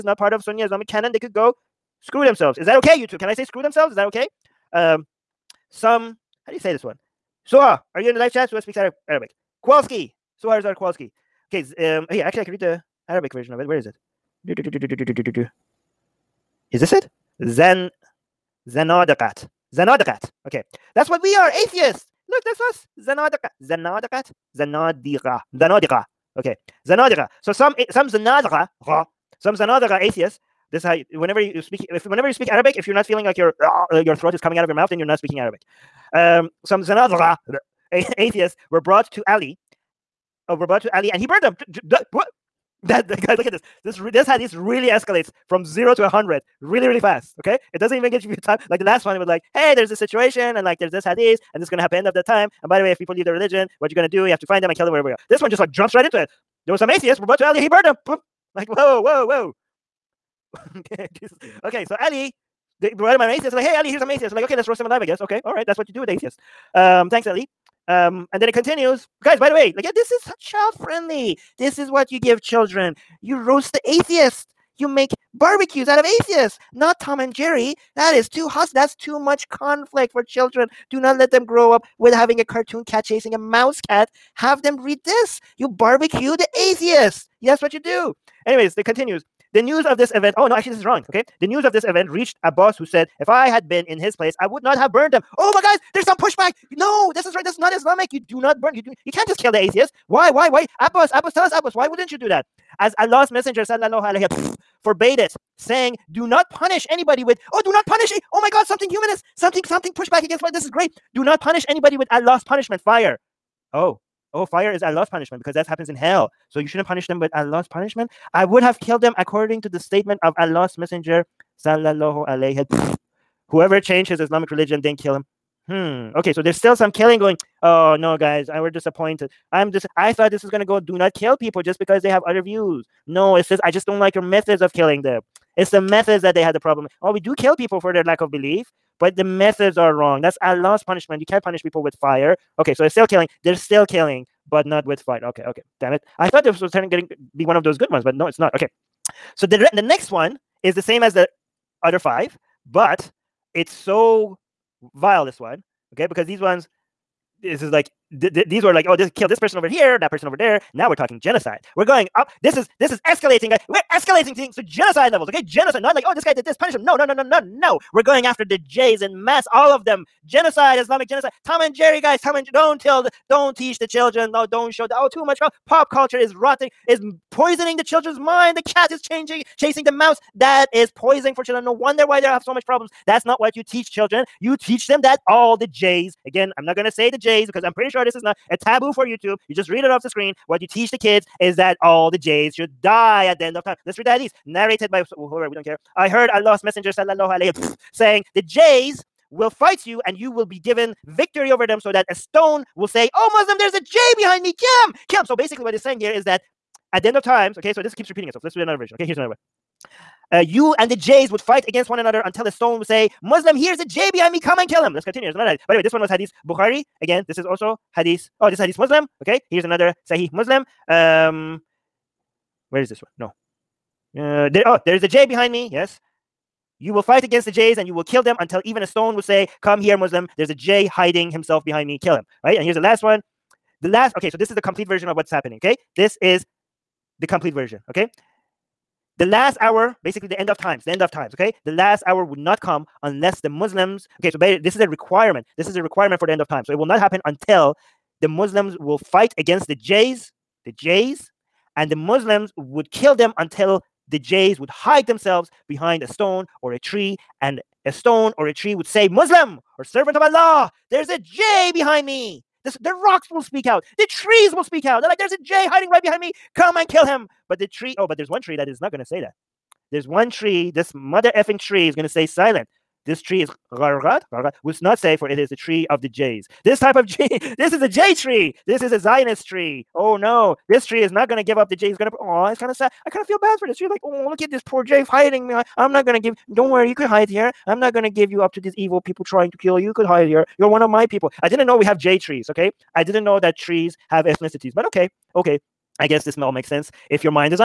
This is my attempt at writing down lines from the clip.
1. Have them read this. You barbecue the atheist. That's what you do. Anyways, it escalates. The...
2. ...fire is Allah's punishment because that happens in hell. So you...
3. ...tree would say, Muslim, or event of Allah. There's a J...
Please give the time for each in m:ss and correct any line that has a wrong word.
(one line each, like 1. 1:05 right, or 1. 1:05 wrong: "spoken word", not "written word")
1. 1:24 wrong: "continues", not "escalates"
2. 1:54 right
3. 4:18 wrong: "servant", not "event".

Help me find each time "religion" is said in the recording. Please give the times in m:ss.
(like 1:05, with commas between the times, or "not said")
0:53, 2:04.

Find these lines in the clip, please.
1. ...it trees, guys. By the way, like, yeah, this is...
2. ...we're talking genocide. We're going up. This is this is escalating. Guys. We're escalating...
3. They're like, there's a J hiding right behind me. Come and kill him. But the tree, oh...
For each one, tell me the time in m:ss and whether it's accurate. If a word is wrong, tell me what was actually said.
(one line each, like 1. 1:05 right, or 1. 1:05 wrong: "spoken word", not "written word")
1. 1:08 wrong: "continues", not "trees"
2. 2:40 right
3. 4:25 right.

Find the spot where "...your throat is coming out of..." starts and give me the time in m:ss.
0:34.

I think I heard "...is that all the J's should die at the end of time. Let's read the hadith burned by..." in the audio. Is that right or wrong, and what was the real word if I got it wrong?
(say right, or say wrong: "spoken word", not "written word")
wrong: "narrated", not "burned".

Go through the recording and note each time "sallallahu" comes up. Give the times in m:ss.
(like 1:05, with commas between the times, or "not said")
1:43, 2:01, 3:16.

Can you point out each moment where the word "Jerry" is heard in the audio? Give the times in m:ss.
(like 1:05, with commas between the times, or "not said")
1:17, 2:51.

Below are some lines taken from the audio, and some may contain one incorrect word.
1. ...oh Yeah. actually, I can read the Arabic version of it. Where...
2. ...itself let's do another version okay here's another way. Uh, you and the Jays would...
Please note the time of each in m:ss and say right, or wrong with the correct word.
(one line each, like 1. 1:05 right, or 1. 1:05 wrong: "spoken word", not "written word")
1. 0:12 right
2. 3:28 right.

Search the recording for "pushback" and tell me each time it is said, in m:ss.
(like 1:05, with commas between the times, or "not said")
1:36, 1:49.